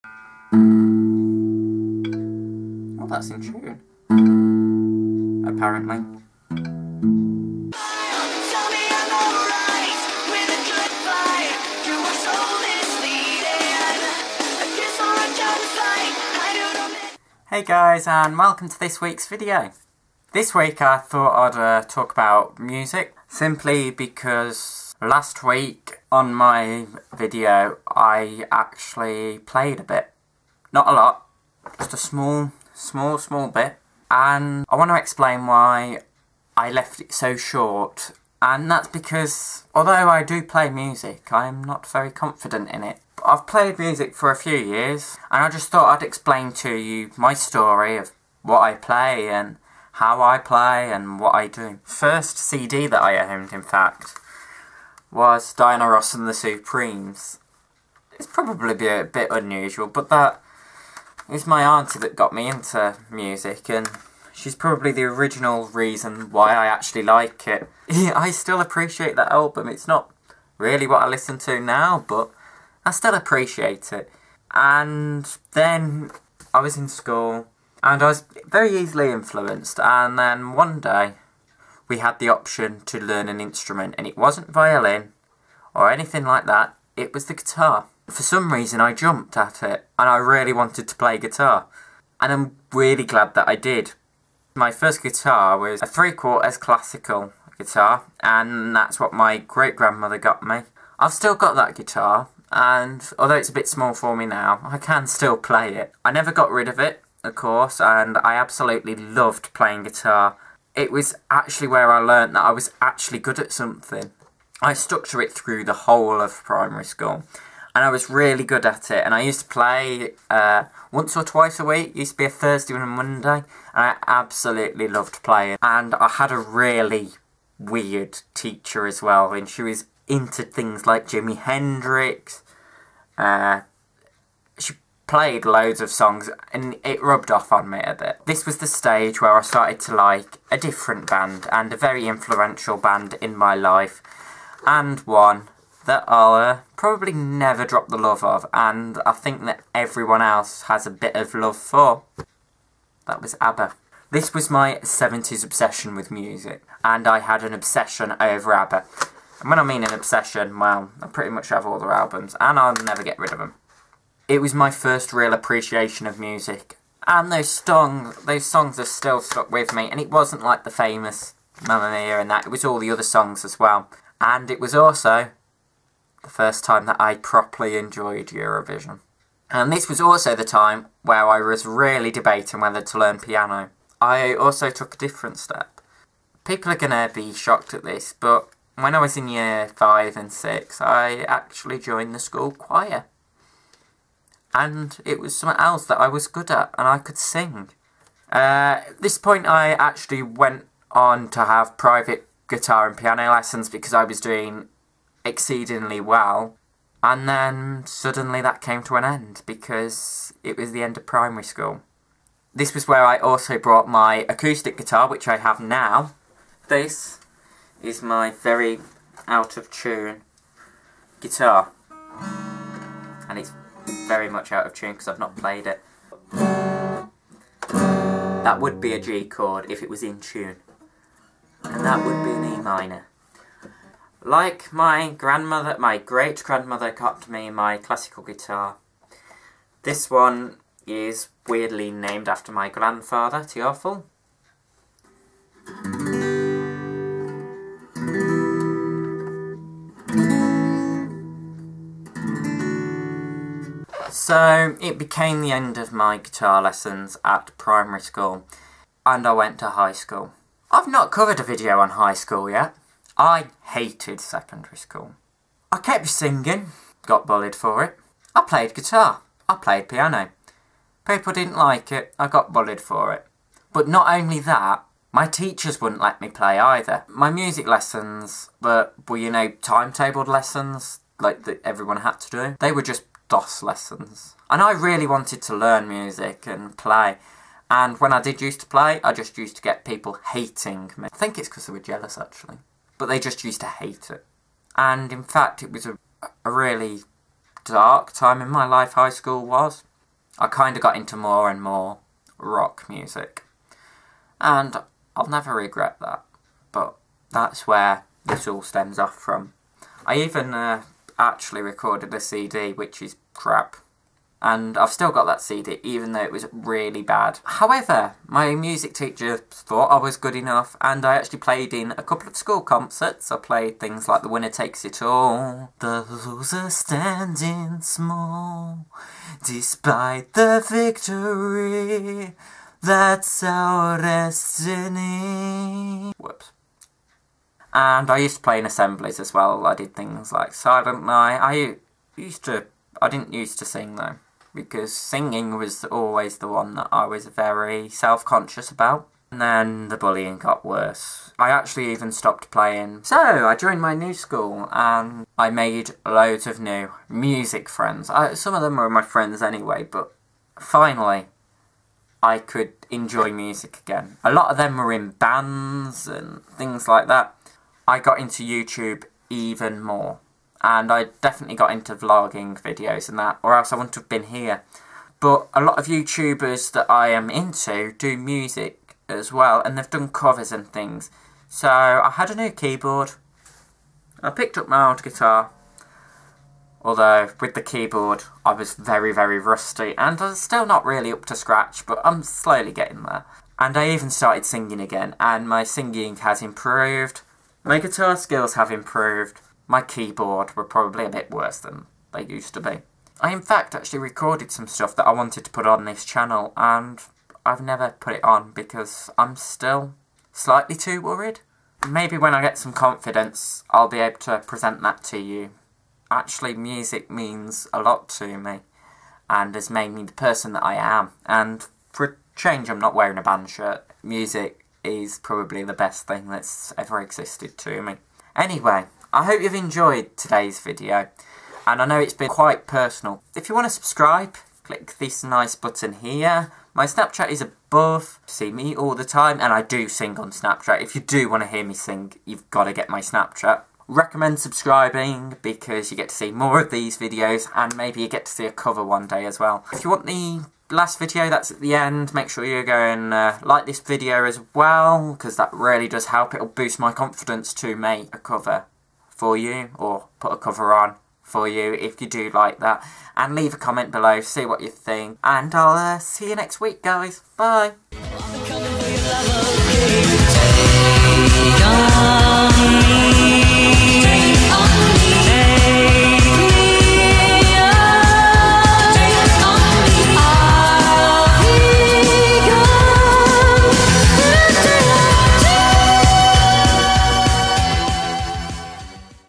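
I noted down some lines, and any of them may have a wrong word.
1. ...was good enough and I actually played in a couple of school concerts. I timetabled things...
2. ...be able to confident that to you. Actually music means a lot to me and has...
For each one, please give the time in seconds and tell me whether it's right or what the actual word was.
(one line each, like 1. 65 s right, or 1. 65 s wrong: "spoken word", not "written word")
1. 320 s wrong: "played", not "timetabled"
2. 413 s wrong: "present", not "confident".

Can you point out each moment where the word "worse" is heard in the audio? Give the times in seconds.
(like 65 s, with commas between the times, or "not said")
350 s, 401 s.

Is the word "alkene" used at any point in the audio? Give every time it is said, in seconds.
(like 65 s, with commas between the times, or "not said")
not said.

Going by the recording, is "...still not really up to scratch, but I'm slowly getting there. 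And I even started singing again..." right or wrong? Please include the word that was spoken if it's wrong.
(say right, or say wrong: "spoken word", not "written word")
right.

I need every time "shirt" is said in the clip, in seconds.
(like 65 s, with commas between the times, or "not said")
423 s.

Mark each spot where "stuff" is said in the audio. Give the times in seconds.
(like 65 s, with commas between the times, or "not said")
404 s.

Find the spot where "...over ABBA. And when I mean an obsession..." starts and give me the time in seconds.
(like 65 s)
158 s.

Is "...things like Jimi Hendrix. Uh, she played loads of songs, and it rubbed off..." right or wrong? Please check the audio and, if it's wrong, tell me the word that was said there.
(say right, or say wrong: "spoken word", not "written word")
right.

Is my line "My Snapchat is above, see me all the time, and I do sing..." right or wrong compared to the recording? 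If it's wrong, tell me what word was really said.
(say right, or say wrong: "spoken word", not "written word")
right.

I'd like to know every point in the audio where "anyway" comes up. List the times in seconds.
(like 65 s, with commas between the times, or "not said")
359 s, 428 s.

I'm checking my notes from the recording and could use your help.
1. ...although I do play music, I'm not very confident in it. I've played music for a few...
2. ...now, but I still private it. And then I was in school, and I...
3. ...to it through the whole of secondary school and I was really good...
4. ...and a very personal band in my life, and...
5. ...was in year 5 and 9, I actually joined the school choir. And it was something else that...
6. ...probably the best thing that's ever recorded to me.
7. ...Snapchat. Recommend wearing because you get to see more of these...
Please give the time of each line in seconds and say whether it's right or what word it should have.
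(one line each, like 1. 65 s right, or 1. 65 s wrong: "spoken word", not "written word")
1. 39 s right
2. 71 s wrong: "appreciate", not "private"
3. 115 s wrong: "primary", not "secondary"
4. 141 s wrong: "influential", not "personal"
5. 188 s wrong: "6", not "9"
6. 425 s wrong: "existed", not "recorded"
7. 443 s wrong: "subscribing", not "wearing".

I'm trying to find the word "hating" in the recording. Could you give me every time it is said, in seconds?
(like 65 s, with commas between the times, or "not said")
290 s.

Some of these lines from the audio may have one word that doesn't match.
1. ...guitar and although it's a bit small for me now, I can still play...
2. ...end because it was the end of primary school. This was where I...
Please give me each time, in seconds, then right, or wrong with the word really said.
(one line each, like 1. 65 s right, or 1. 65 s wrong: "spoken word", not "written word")
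1. 101 s right
2. 209 s right.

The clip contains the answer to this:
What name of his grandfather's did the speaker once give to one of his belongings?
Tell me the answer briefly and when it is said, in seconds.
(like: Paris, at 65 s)
Teofil, at 243 s.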